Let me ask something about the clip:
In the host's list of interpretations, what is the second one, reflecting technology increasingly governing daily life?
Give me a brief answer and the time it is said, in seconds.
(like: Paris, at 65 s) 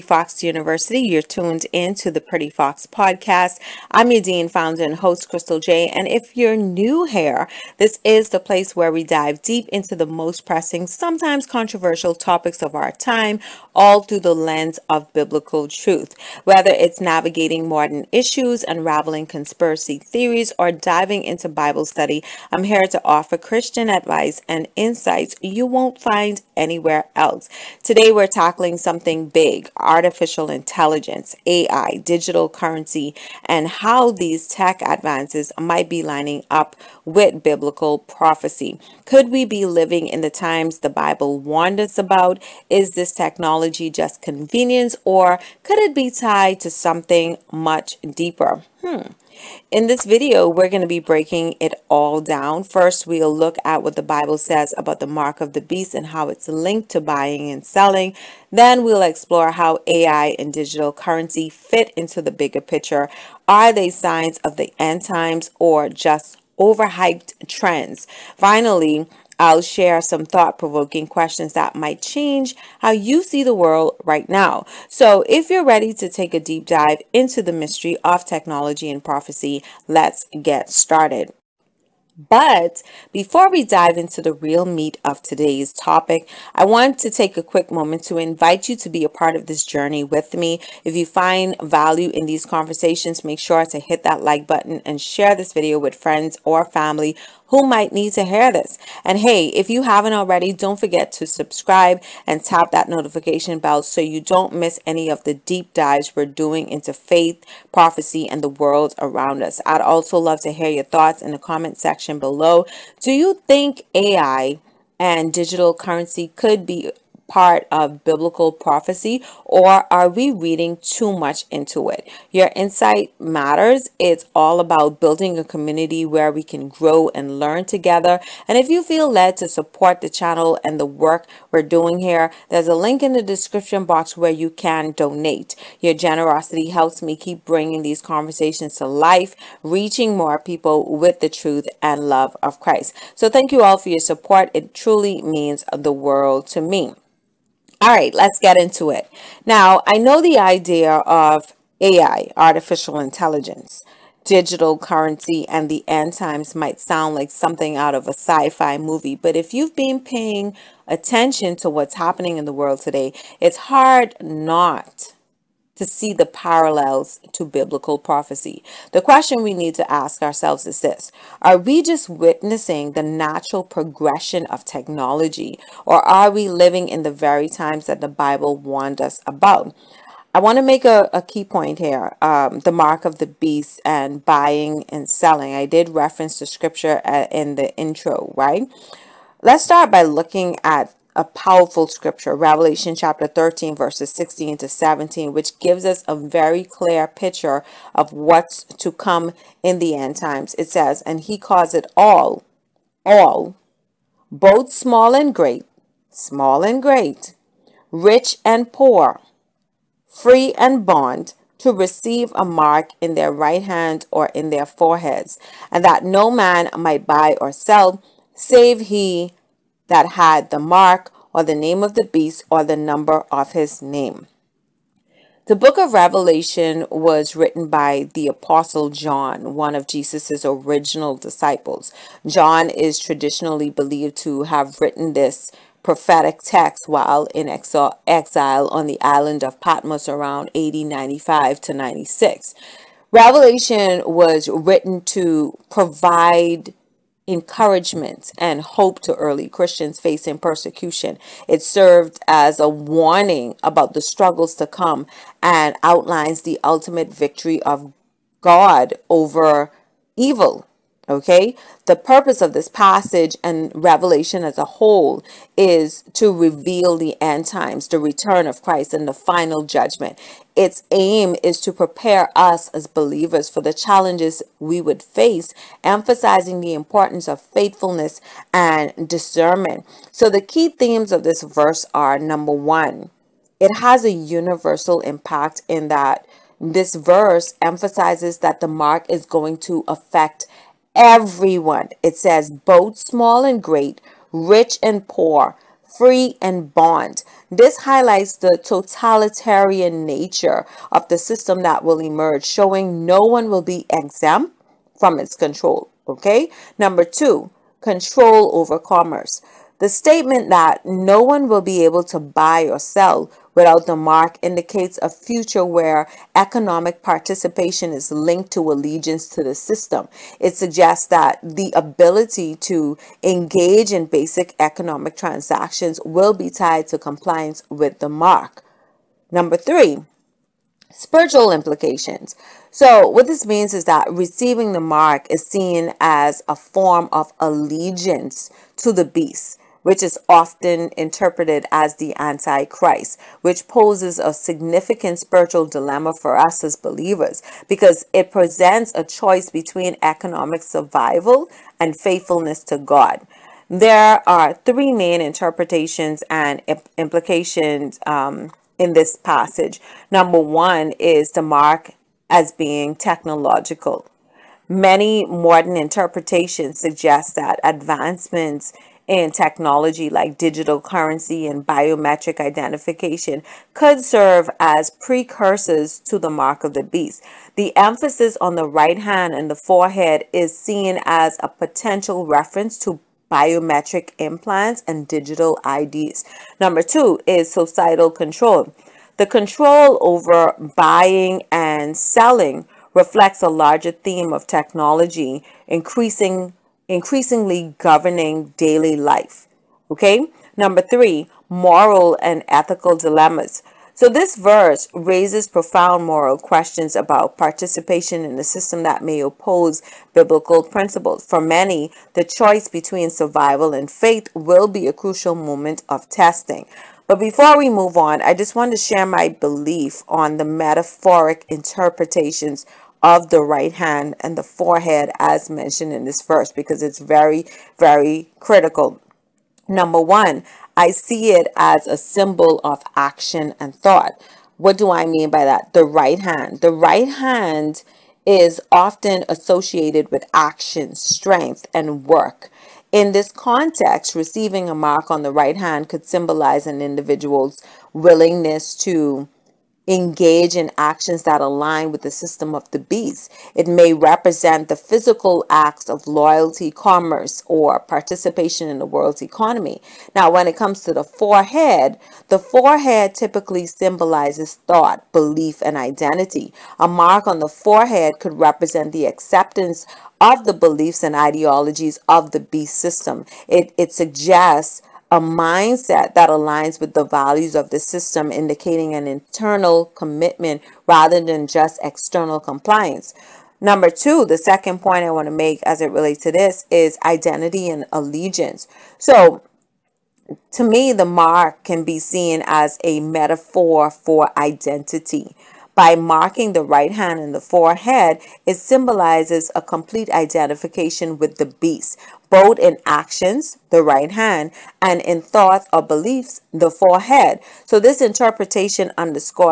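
Societal control, at 387 s.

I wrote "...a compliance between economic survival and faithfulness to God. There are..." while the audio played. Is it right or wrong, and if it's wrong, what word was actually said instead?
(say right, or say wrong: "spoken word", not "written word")
wrong: "choice", not "compliance".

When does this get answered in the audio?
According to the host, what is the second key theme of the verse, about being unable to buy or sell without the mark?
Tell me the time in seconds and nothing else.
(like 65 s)
307 s.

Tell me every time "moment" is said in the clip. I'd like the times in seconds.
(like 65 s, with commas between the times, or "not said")
87 s, 415 s.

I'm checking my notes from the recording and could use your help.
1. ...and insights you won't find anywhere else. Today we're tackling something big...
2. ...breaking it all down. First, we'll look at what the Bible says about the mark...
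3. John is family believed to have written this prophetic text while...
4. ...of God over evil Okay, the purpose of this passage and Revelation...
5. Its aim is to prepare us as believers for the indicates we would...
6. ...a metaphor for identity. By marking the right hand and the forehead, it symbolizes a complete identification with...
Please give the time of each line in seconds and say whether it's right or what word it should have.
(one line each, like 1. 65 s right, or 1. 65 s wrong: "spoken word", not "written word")
1. 24 s right
2. 50 s right
3. 232 s wrong: "traditionally", not "family"
4. 257 s right
5. 270 s wrong: "challenges", not "indicates"
6. 492 s right.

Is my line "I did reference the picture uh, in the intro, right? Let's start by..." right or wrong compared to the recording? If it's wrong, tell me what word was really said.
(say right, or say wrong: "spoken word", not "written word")
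wrong: "scripture", not "picture".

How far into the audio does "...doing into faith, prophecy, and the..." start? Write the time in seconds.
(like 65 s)
106 s.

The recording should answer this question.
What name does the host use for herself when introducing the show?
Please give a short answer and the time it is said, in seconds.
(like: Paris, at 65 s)
Crystal J, at 5 s.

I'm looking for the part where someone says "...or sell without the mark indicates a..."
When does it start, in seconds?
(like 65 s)
312 s.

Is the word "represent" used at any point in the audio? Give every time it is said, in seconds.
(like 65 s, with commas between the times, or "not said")
453 s, 468 s.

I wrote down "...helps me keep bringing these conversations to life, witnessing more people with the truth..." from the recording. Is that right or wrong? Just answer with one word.
wrong.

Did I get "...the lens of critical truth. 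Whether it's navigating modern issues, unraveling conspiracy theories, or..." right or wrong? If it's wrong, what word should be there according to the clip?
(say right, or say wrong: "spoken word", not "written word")
wrong: "biblical", not "critical".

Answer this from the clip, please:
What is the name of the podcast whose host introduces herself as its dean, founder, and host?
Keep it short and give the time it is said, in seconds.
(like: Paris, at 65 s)
Pretty Fox, at 2 s.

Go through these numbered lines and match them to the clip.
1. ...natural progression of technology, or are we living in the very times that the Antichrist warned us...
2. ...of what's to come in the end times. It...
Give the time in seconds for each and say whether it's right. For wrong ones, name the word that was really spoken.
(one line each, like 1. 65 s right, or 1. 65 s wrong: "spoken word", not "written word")
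1. 173 s wrong: "Bible", not "Antichrist"
2. 197 s right.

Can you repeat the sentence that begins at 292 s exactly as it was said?
It says both small and great, rich and poor, free and bond.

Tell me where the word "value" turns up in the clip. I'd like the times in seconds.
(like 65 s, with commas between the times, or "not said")
91 s, 477 s.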